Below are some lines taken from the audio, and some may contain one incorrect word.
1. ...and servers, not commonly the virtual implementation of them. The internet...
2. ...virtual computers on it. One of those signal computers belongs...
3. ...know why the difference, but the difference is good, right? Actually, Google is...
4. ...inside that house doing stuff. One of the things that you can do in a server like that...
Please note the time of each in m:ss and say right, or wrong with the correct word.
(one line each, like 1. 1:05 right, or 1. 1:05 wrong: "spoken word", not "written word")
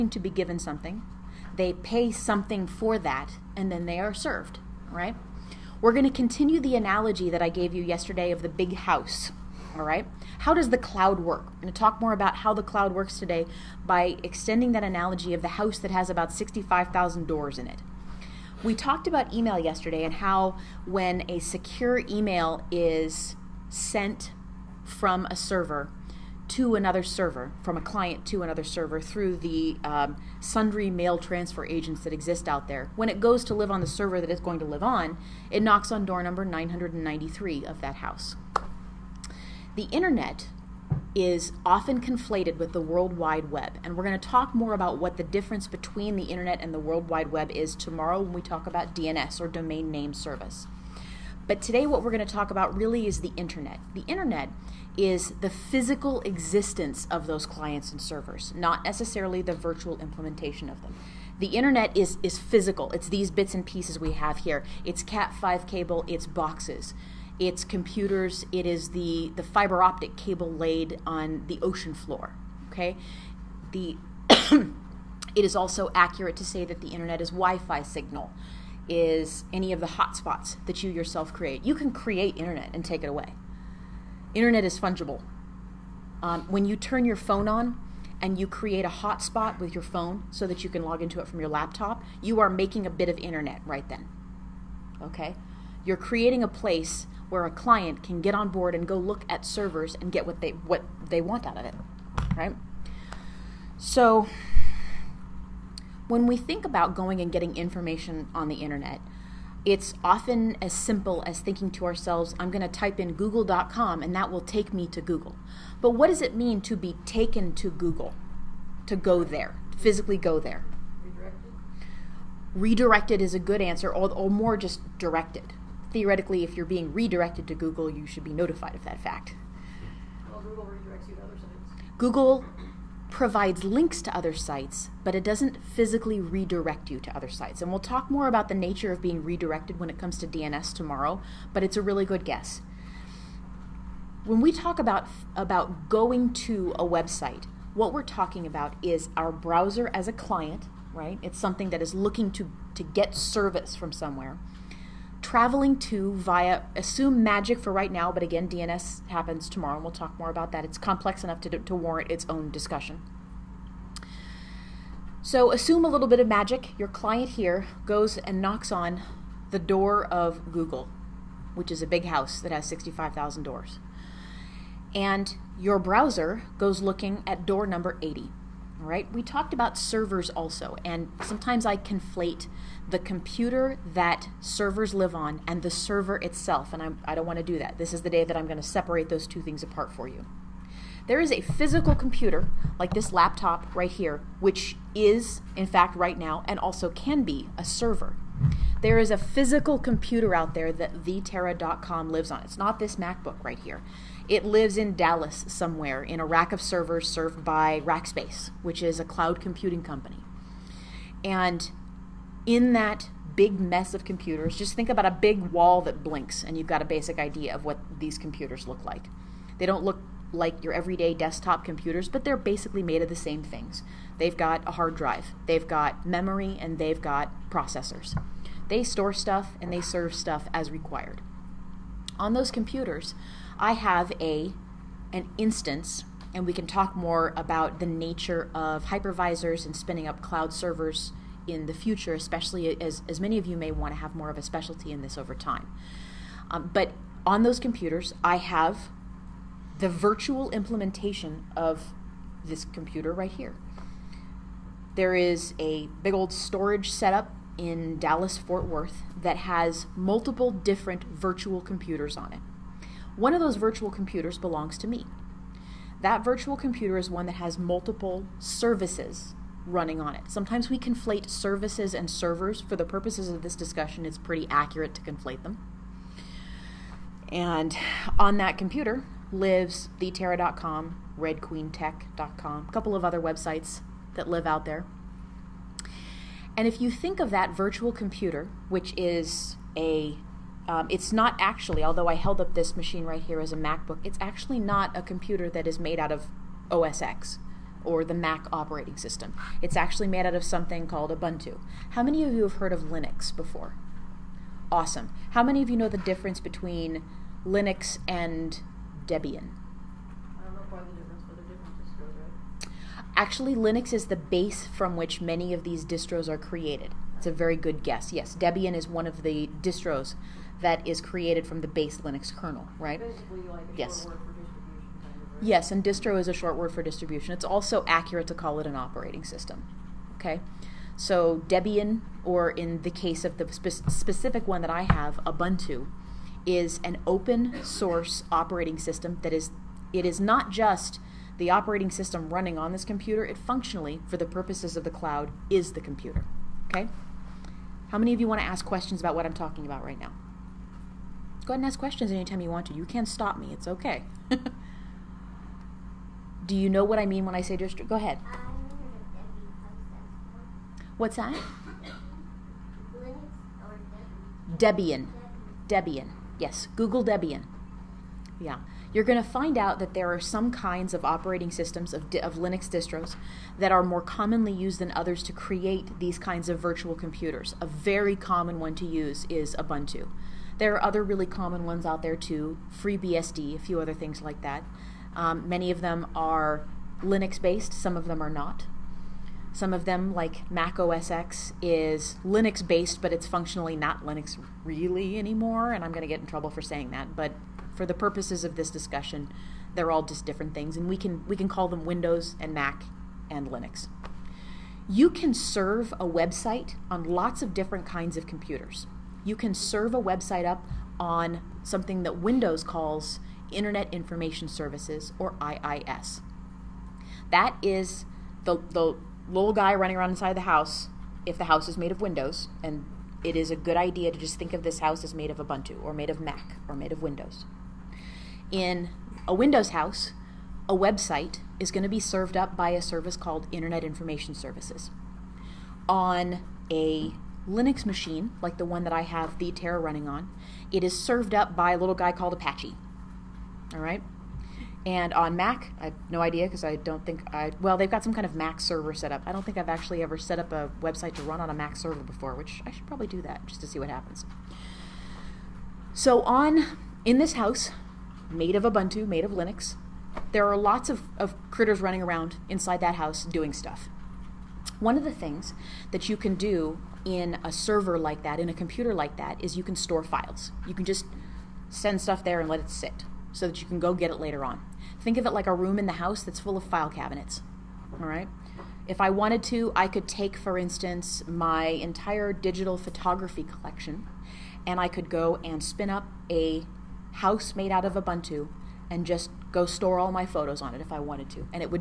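1. 0:57 wrong: "necessarily", not "commonly"
2. 4:21 wrong: "virtual", not "signal"
3. 5:10 wrong: "Linux", not "Google"
4. 7:42 right.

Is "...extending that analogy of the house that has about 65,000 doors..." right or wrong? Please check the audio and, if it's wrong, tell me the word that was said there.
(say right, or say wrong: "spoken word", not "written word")
right.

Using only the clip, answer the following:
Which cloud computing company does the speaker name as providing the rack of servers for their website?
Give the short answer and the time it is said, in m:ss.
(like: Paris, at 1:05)
Rackspace, at 3:27.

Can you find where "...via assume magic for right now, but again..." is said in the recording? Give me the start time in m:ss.
2:36.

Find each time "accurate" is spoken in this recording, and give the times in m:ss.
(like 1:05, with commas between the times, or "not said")
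1:15, 4:34, 5:27.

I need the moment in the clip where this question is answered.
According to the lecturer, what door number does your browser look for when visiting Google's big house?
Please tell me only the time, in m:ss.
2:57.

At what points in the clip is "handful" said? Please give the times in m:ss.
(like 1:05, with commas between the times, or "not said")
not said.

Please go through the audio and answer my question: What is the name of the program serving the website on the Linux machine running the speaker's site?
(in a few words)
Apache.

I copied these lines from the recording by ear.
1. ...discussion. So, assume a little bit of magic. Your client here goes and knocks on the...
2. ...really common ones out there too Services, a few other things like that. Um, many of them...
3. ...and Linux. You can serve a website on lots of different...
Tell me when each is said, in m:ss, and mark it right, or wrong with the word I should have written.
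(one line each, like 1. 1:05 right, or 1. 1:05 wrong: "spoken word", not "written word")
1. 2:42 right
2. 6:21 wrong: "FreeBSD", not "Services"
3. 6:43 right.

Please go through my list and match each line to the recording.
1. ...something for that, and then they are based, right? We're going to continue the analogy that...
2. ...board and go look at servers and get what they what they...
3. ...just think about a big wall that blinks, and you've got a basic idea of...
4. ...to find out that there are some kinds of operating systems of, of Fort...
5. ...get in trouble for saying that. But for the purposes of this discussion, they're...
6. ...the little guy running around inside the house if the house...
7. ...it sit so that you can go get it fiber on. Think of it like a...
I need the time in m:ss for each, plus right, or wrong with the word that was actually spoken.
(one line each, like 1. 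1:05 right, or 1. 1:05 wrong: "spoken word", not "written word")
1. 0:02 wrong: "served", not "based"
2. 1:38 right
3. 3:34 right
4. 6:09 wrong: "Linux", not "Fort"
5. 6:36 right
6. 6:58 right
7. 7:52 wrong: "later", not "fiber".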